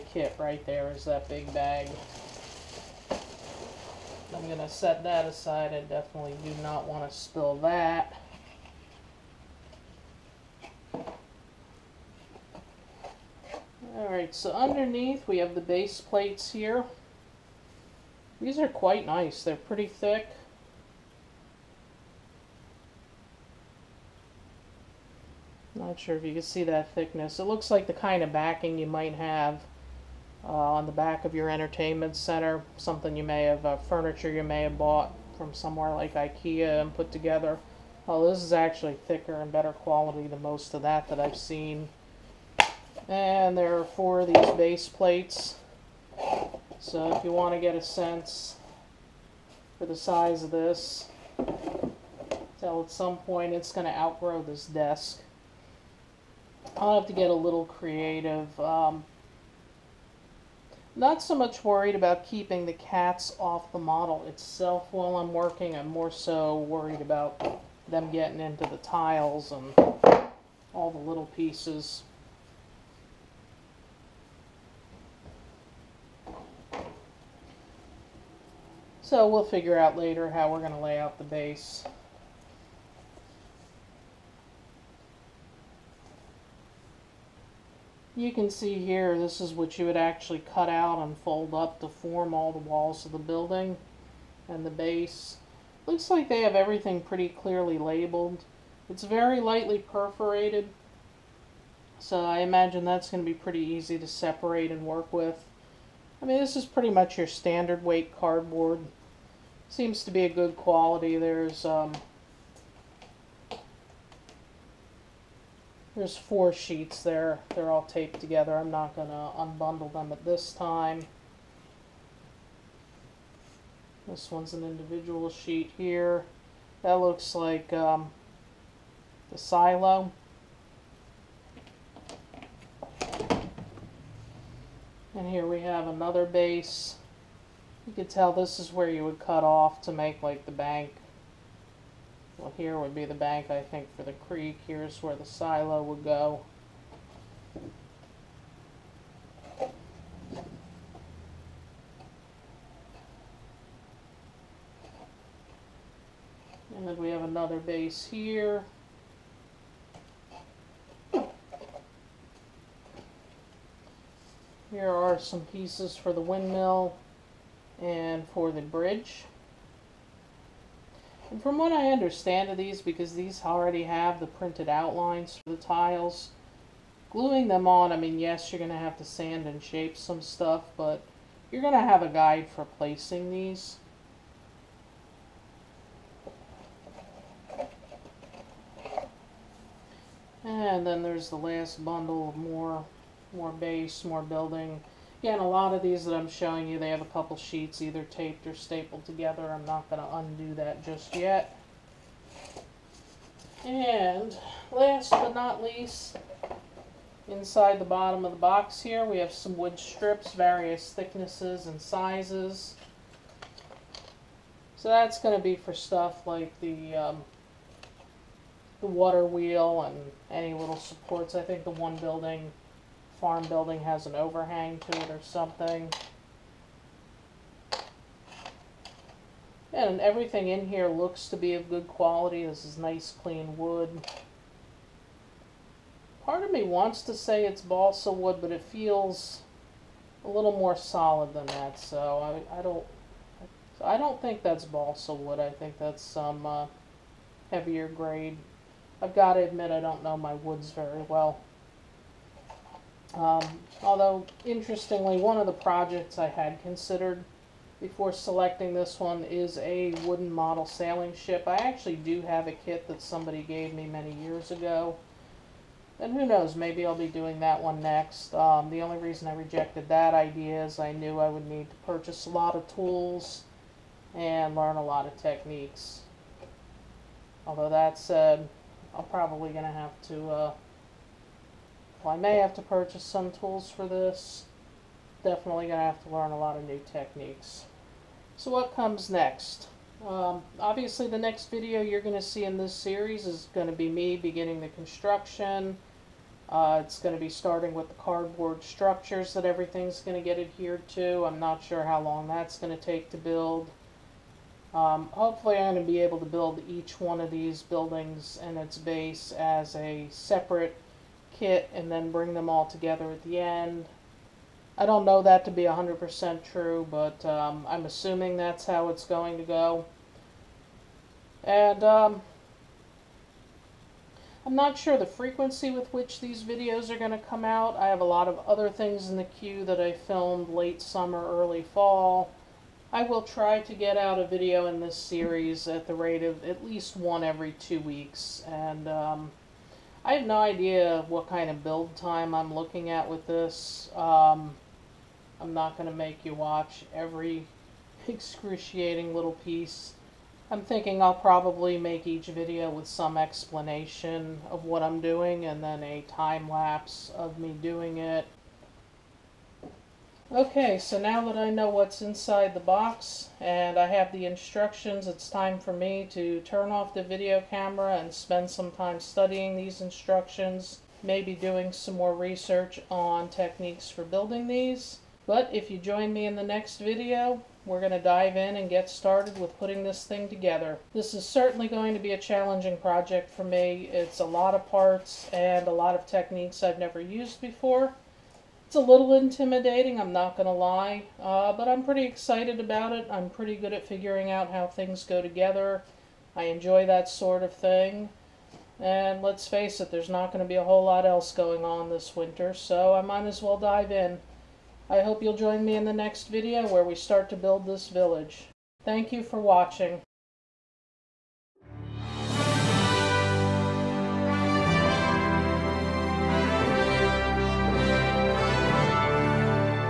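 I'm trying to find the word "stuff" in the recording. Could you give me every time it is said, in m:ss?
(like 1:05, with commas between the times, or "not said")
3:00, 3:35.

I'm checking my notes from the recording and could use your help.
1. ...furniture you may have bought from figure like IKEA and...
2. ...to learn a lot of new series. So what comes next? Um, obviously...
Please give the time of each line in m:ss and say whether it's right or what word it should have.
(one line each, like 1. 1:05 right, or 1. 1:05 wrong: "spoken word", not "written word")
1. 0:33 wrong: "somewhere", not "figure"
2. 4:46 wrong: "techniques", not "series".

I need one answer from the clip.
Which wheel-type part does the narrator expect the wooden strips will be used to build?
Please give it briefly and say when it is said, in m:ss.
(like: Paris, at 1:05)
Water wheel, at 3:38.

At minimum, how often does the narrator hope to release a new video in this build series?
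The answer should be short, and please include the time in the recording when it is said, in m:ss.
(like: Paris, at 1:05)
Every two weeks, at 5:36.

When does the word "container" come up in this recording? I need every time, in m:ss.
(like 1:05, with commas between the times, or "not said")
not said.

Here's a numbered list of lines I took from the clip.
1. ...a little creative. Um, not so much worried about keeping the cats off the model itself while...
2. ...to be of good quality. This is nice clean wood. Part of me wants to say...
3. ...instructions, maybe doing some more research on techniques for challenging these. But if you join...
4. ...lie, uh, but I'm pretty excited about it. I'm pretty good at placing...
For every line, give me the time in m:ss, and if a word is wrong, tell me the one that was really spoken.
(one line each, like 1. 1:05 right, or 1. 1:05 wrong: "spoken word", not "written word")
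1. 0:57 right
2. 3:51 right
3. 6:09 wrong: "building", not "challenging"
4. 6:30 wrong: "figuring", not "placing".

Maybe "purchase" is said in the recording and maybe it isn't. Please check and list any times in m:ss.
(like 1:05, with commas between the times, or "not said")
4:31, 4:42.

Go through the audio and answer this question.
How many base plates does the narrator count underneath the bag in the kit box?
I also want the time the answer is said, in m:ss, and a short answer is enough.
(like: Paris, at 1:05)
4, at 0:43.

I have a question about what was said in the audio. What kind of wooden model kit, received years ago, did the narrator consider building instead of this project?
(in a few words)
Sailing ship.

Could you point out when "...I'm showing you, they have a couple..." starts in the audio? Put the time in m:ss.
3:16.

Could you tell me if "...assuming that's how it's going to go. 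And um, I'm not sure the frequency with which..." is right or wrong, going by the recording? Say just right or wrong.
right.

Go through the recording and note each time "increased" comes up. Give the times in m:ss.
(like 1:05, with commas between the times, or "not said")
not said.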